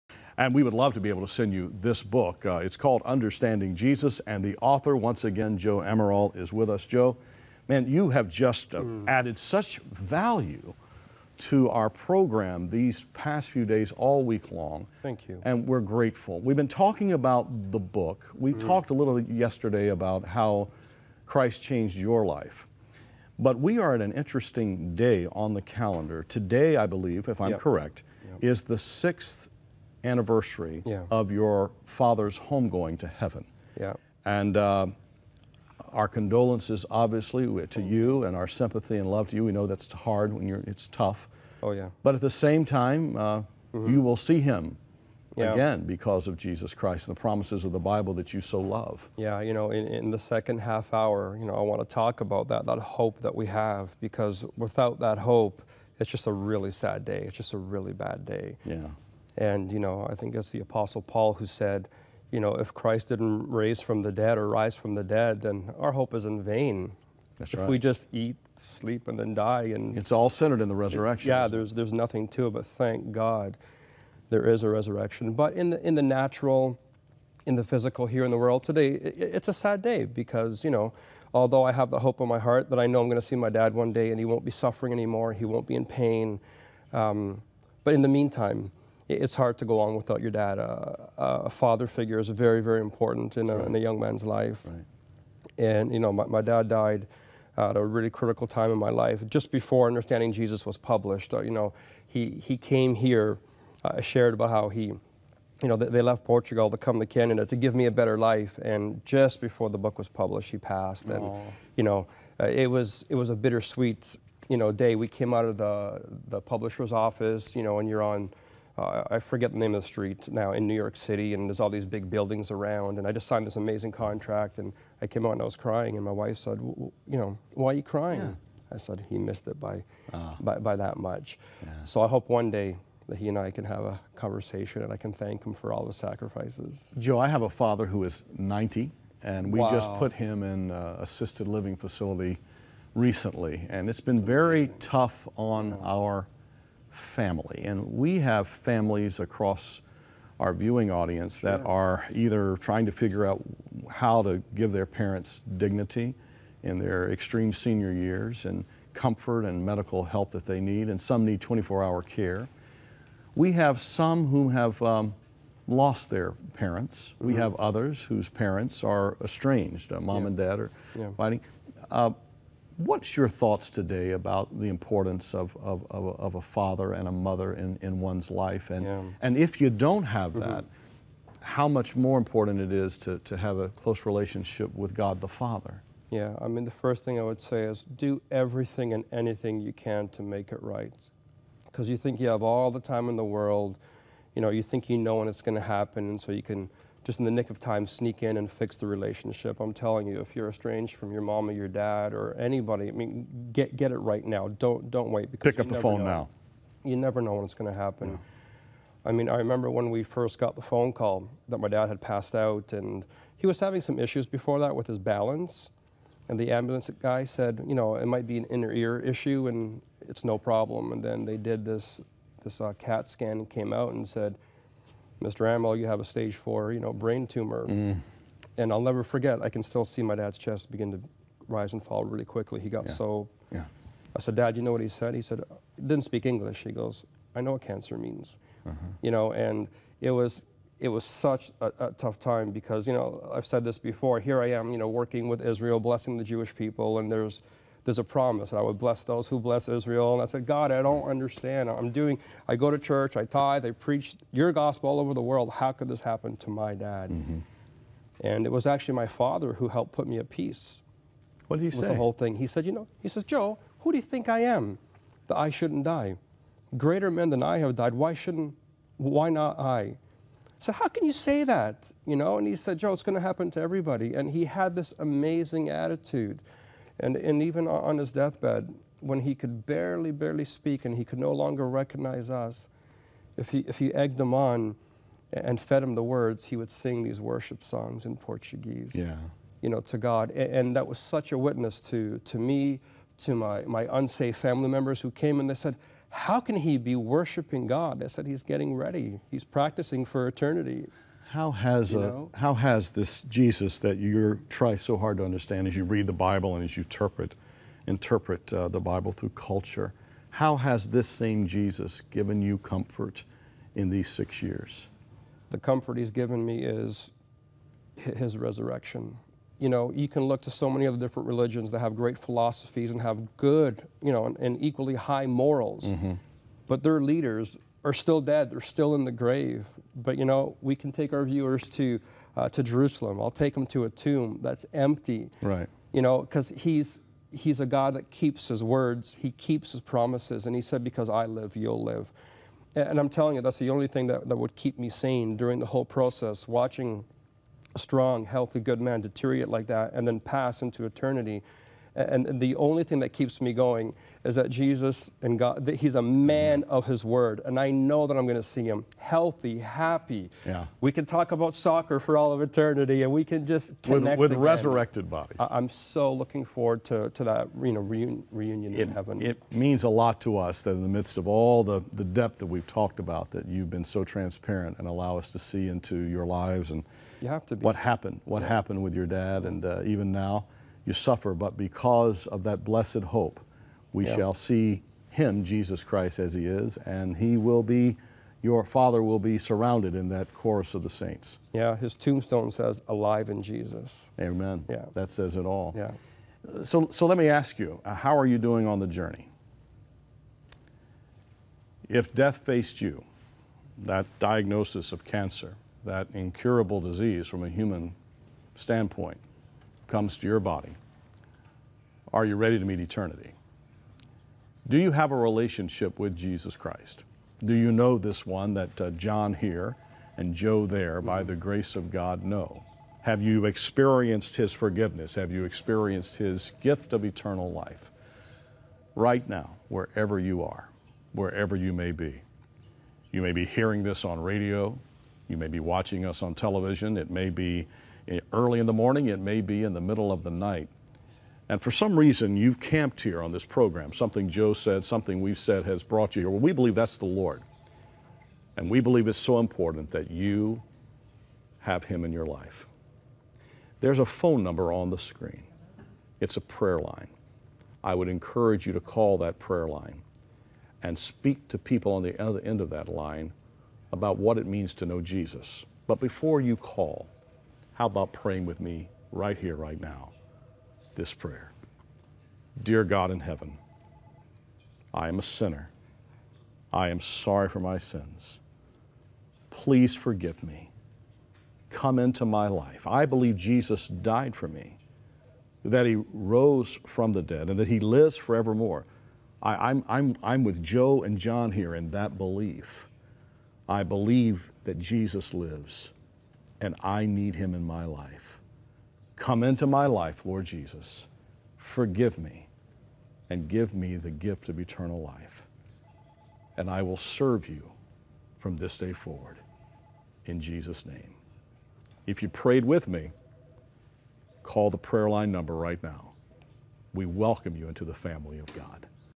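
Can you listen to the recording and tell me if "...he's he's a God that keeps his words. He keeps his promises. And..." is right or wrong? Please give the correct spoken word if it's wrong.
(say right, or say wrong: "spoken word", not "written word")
right.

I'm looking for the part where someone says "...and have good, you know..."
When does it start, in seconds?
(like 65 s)
322 s.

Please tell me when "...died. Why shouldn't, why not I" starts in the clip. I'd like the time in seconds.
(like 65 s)
267 s.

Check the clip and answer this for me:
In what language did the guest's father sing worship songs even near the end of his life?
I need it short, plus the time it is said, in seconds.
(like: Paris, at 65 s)
Portuguese, at 288 s.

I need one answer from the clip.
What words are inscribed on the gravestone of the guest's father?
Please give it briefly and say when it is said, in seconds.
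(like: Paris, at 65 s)
Alive in Jesus, at 392 s.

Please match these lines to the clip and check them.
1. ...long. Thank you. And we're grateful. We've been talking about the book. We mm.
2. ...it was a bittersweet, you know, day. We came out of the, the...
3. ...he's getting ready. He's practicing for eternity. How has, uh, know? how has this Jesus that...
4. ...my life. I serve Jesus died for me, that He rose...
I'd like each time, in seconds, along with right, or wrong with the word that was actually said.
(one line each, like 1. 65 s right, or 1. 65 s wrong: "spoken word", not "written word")
1. 14 s right
2. 113 s right
3. 298 s right
4. 482 s wrong: "believe", not "serve".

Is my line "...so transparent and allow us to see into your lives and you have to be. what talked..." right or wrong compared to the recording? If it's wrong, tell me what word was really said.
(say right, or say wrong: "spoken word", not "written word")
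wrong: "happened", not "talked".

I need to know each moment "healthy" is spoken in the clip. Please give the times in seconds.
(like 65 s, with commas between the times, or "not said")
348 s, 358 s.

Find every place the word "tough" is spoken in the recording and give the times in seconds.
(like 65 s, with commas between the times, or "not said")
40 s, 144 s, 241 s.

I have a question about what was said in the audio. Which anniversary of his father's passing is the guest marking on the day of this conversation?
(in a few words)
Sixth.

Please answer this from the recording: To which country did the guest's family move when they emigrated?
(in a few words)
Canada.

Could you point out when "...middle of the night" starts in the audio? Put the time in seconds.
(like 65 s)
439 s.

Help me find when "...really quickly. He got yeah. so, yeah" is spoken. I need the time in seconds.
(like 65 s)
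232 s.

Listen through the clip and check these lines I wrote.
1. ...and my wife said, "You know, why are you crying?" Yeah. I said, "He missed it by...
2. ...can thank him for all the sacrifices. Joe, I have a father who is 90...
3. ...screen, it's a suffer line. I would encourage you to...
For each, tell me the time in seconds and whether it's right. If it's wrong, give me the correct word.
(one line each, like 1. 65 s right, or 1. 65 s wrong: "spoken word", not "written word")
1. 125 s right
2. 134 s right
3. 454 s wrong: "prayer", not "suffer".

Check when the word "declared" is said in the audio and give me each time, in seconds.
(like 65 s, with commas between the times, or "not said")
not said.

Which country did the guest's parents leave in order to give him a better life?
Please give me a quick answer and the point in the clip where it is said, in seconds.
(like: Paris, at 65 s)
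Portugal, at 106 s.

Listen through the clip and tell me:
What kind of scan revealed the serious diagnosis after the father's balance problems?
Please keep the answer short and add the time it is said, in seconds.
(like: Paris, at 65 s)
CAT scan, at 222 s.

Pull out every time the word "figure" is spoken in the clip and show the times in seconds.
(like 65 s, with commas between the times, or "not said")
91 s, 152 s.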